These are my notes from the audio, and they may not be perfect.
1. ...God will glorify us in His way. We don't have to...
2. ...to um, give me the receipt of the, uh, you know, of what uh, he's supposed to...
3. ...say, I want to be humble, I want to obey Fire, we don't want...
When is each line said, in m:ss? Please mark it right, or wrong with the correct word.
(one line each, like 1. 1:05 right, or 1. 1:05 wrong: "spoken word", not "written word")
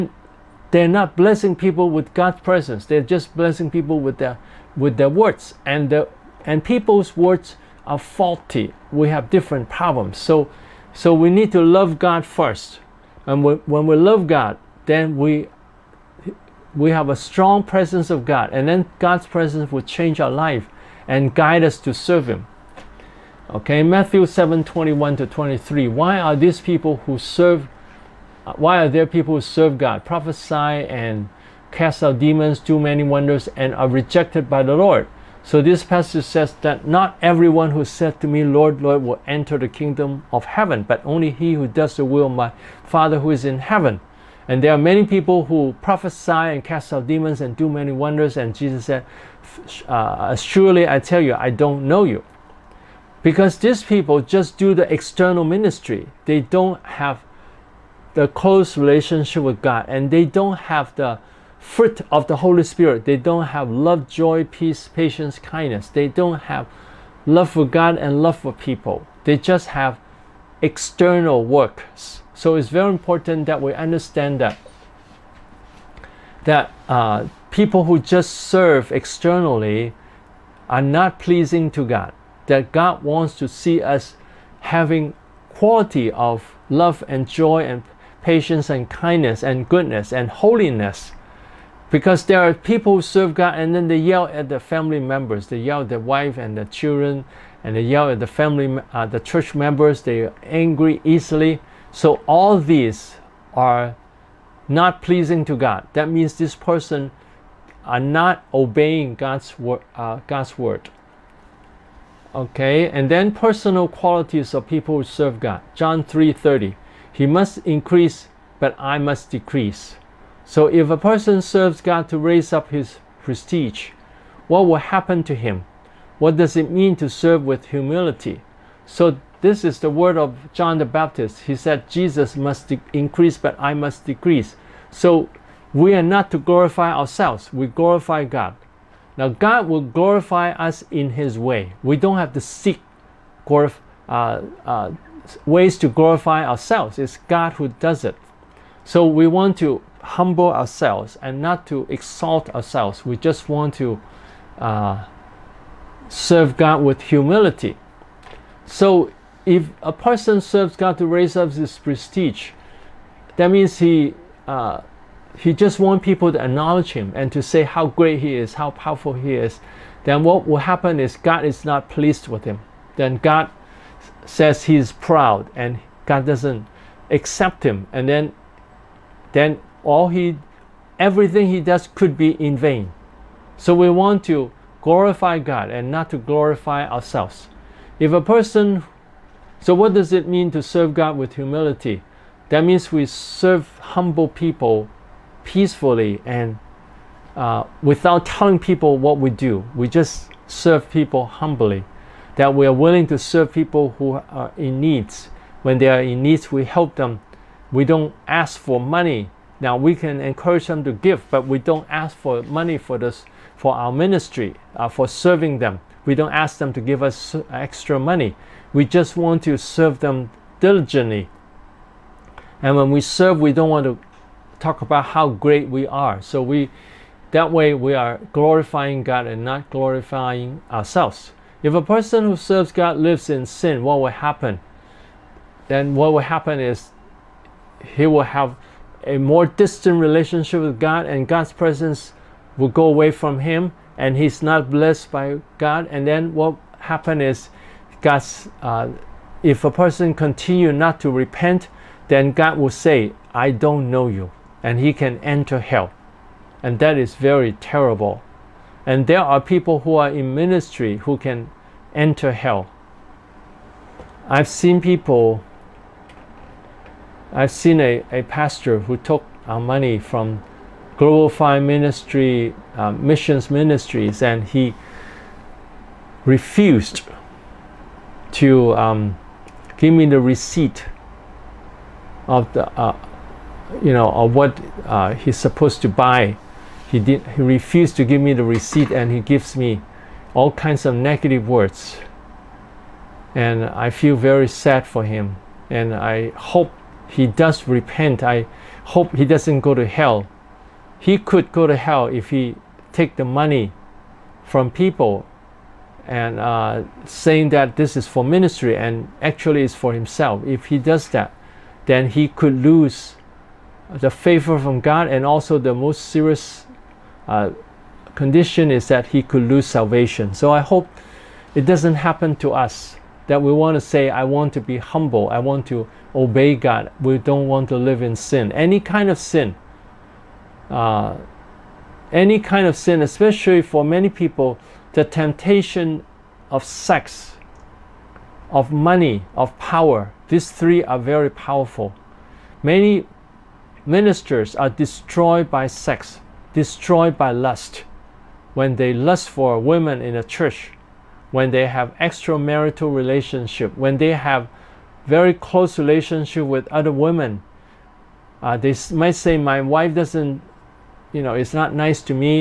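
1. 2:19 right
2. 4:38 right
3. 5:23 wrong: "God", not "Fire".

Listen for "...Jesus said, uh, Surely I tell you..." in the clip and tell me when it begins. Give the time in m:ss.
0:48.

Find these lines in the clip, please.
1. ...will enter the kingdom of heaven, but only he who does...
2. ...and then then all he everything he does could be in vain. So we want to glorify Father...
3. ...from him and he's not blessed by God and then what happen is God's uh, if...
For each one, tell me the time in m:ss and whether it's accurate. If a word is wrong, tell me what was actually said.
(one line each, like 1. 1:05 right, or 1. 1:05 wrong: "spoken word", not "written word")
1. 0:39 right
2. 2:57 wrong: "God", not "Father"
3. 4:03 right.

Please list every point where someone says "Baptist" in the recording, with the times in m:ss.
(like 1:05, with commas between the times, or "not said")
2:10.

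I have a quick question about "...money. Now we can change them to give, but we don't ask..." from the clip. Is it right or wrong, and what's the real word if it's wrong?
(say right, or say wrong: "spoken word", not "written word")
wrong: "encourage", not "change".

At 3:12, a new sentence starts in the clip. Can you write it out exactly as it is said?
That means we serve humble people peacefully and uh, without telling people what we do.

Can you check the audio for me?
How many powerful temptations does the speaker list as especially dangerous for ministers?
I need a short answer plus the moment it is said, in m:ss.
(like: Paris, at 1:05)
3, at 5:40.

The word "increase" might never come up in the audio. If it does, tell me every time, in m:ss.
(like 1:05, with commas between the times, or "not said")
1:57, 2:12.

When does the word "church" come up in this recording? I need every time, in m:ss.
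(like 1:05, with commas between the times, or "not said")
1:39, 5:50.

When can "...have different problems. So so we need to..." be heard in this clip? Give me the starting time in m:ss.
0:09.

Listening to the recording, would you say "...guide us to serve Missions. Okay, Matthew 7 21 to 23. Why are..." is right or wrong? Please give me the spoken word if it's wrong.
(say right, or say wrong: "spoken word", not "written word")
wrong: "Him", not "Missions".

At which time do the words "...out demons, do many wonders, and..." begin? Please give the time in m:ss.
0:32.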